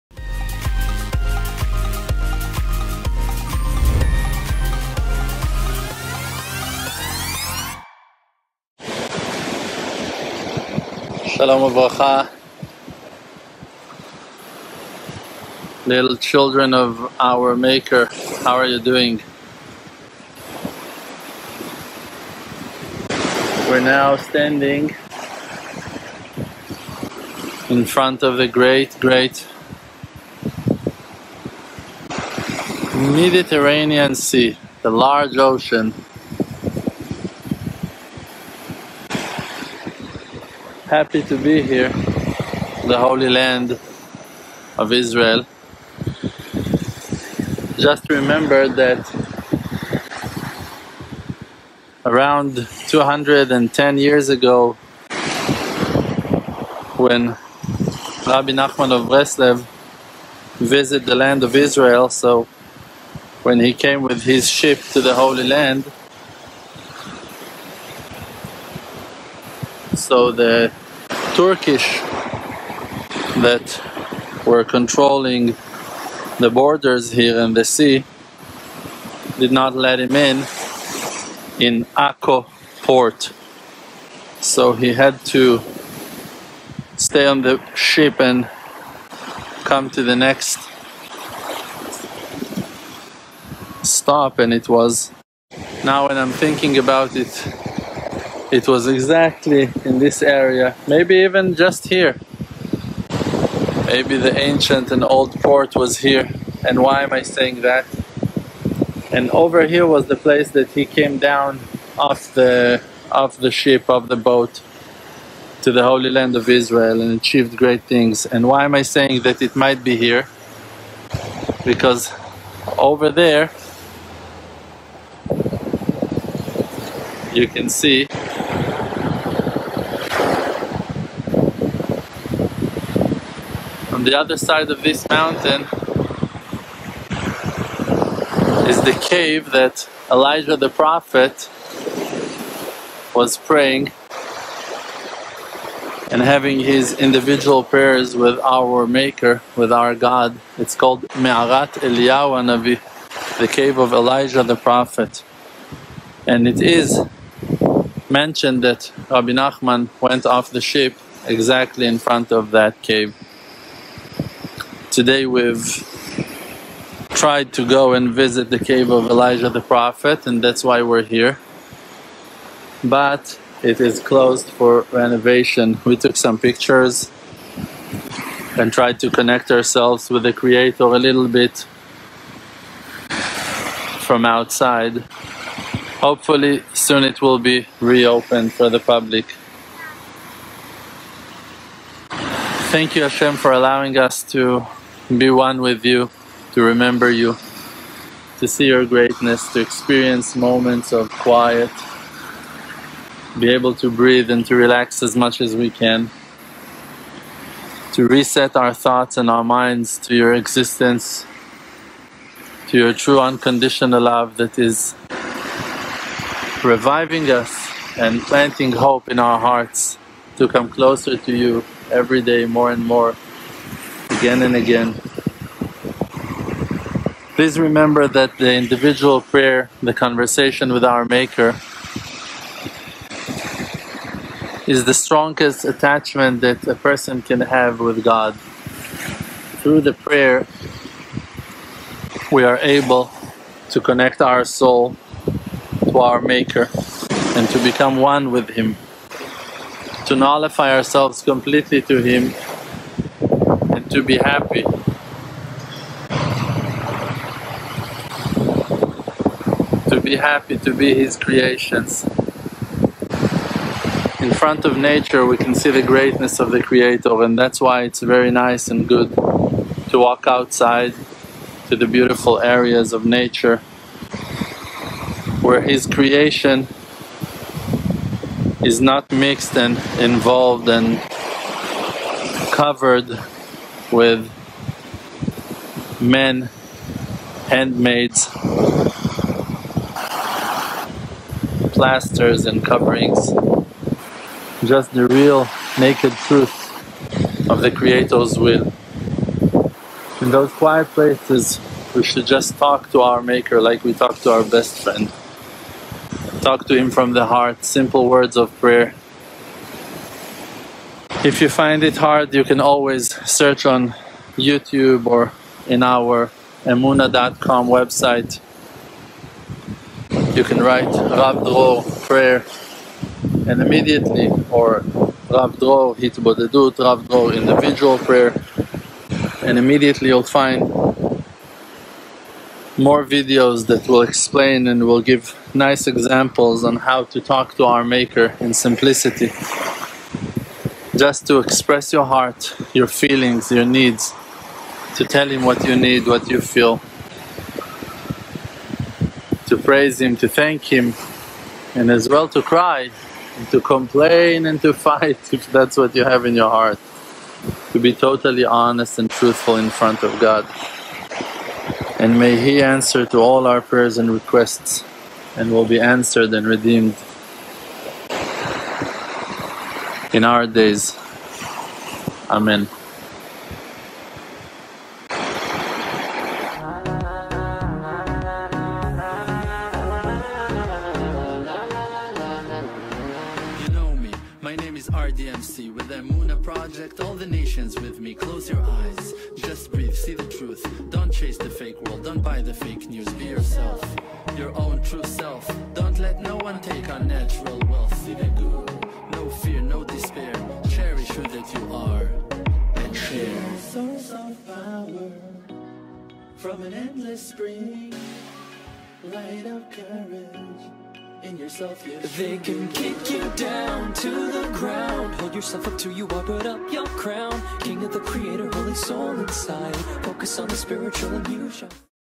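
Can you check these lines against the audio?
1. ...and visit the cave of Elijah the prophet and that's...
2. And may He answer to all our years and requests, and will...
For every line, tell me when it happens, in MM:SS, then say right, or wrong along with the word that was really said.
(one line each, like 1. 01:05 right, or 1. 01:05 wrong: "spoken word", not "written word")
1. 02:47 right
2. 06:01 wrong: "prayers", not "years".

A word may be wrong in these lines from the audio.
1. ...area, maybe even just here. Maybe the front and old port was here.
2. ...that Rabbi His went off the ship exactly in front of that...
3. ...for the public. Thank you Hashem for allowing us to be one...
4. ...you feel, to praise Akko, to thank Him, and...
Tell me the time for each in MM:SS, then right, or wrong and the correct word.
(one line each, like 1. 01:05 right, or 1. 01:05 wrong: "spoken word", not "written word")
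1. 01:40 wrong: "ancient", not "front"
2. 02:38 wrong: "Nachman", not "His"
3. 03:08 right
4. 05:46 wrong: "Him", not "Akko".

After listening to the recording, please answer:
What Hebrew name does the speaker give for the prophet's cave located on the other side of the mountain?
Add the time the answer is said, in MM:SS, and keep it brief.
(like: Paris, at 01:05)
Me'arat Eliyahu Navi, at 02:31.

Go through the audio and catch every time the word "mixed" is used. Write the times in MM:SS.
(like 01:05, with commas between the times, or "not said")
04:39.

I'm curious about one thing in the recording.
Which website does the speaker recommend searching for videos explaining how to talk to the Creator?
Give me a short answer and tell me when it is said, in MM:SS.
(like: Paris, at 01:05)
emunah.com, at 05:16.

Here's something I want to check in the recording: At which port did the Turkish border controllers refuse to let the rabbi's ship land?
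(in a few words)
Akko.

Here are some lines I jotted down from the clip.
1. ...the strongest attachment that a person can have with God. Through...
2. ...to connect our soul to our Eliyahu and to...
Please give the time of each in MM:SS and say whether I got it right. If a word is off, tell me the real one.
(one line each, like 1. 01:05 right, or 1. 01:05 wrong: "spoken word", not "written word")
1. 03:54 right
2. 04:03 wrong: "Maker", not "Eliyahu".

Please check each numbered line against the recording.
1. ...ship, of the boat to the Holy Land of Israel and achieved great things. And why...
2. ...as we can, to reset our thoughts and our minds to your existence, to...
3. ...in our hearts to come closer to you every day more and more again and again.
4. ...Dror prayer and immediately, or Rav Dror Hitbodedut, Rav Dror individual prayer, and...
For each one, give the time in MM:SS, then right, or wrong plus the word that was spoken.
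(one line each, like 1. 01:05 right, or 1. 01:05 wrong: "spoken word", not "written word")
1. 01:53 right
2. 03:25 right
3. 03:39 right
4. 05:21 right.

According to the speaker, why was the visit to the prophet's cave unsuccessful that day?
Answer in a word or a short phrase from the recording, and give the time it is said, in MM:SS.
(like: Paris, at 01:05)
Closed for renovation, at 02:54.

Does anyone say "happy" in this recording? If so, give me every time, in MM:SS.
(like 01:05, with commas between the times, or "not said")
00:40, 04:14, 04:20.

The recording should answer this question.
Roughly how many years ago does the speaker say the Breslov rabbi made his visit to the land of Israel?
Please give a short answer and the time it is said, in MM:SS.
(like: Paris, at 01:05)
210, at 00:52.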